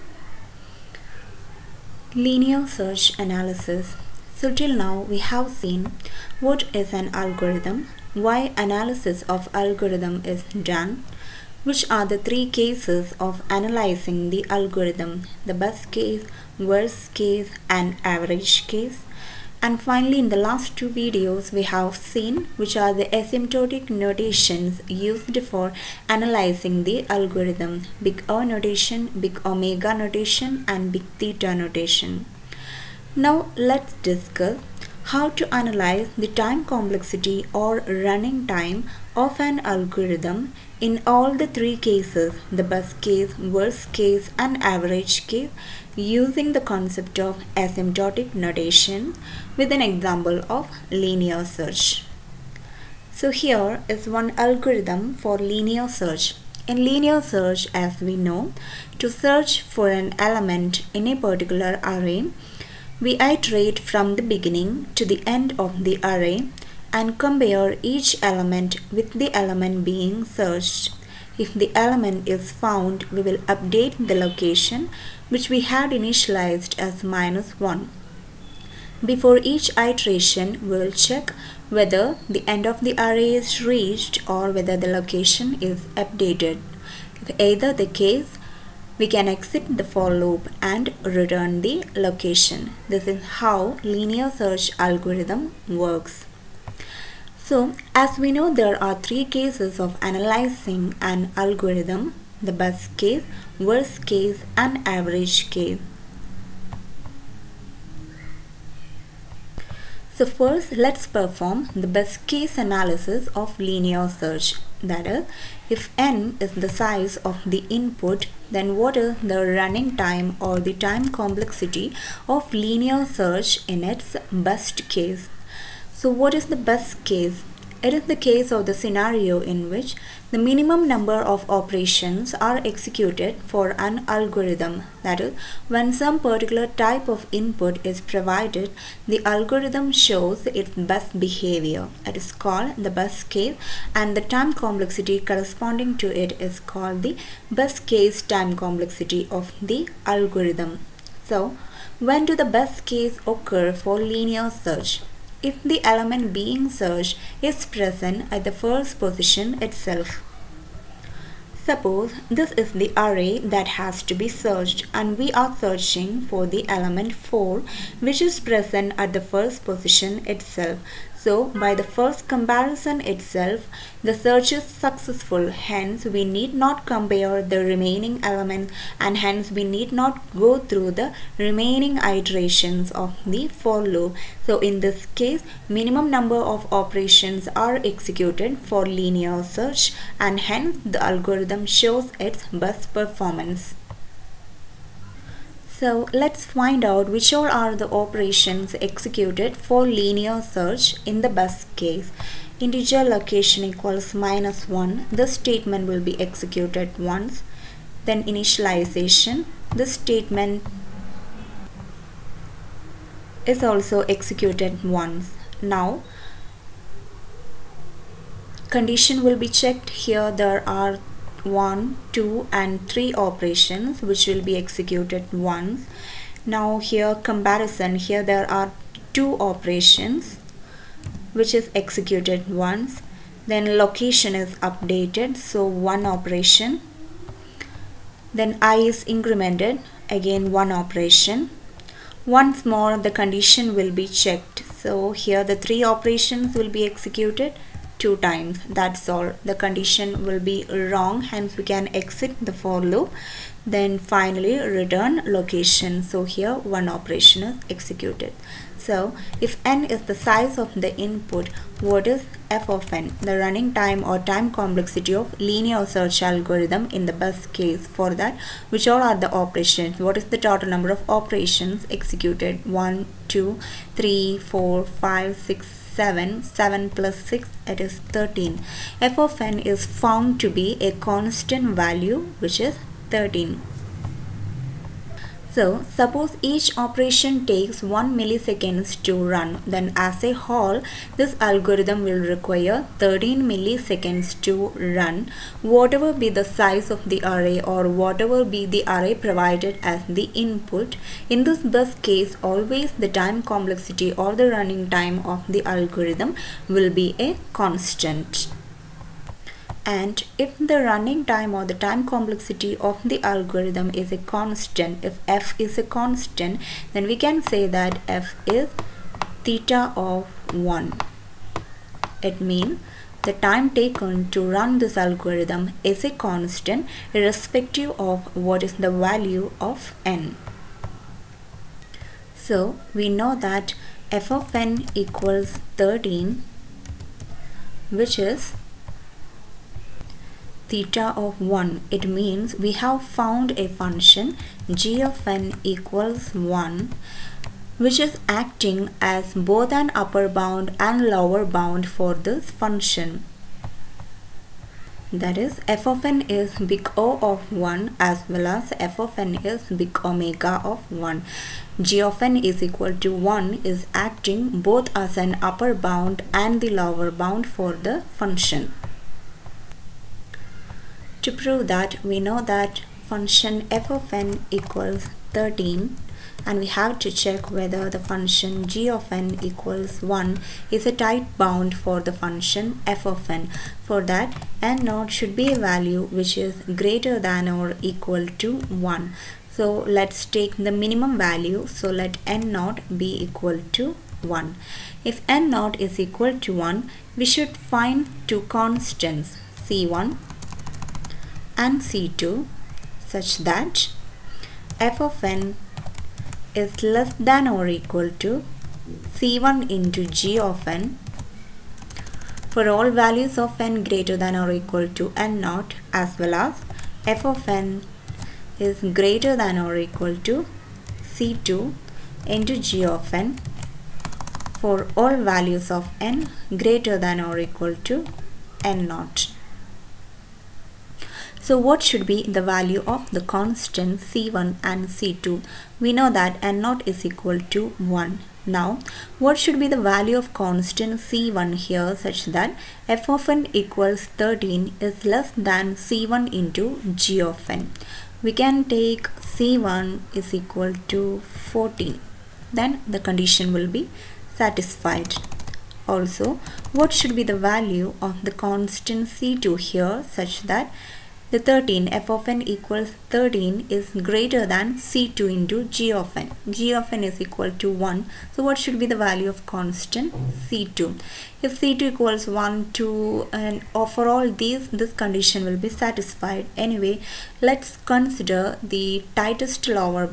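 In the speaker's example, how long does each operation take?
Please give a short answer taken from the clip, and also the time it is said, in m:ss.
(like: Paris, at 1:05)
1 millisecond, at 4:47.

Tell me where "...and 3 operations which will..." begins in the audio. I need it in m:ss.
3:42.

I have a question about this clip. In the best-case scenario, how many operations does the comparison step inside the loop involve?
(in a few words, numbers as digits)
2.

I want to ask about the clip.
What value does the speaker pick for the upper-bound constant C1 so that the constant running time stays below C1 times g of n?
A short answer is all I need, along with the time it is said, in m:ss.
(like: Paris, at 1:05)
14, at 7:31.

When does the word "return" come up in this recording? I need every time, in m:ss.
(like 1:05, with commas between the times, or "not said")
1:31, 4:14.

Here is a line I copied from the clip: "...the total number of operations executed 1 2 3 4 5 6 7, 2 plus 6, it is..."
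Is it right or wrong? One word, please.
wrong.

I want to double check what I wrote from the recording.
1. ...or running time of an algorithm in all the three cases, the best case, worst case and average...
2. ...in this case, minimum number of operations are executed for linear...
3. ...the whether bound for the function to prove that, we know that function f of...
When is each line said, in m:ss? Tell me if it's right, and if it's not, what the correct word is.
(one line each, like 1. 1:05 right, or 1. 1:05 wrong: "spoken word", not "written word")
1. 0:37 right
2. 3:04 right
3. 6:06 wrong: "lower", not "whether".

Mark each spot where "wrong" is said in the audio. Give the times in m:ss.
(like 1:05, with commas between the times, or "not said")
4:10.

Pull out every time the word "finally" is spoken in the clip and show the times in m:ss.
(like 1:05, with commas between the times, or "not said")
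0:19, 4:13.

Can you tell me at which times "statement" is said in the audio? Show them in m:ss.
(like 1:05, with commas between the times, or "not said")
3:25, 3:29.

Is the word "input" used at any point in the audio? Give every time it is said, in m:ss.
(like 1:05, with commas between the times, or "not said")
1:57, 2:17, 4:21, 5:00.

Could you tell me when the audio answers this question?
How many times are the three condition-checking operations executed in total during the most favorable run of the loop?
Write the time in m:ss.
4:07.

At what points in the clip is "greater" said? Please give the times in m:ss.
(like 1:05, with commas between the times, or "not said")
6:26, 6:53, 6:59, 7:06, 7:44.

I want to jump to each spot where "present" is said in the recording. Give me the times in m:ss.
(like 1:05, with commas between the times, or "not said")
2:37, 2:48.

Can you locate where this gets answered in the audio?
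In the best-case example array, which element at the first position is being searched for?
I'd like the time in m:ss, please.
2:46.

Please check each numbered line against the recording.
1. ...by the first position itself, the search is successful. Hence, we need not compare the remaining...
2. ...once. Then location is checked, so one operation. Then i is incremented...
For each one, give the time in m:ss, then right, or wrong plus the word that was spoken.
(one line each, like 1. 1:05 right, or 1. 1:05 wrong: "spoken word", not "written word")
1. 2:51 wrong: "comparison", not "position"
2. 3:52 wrong: "updated", not "checked".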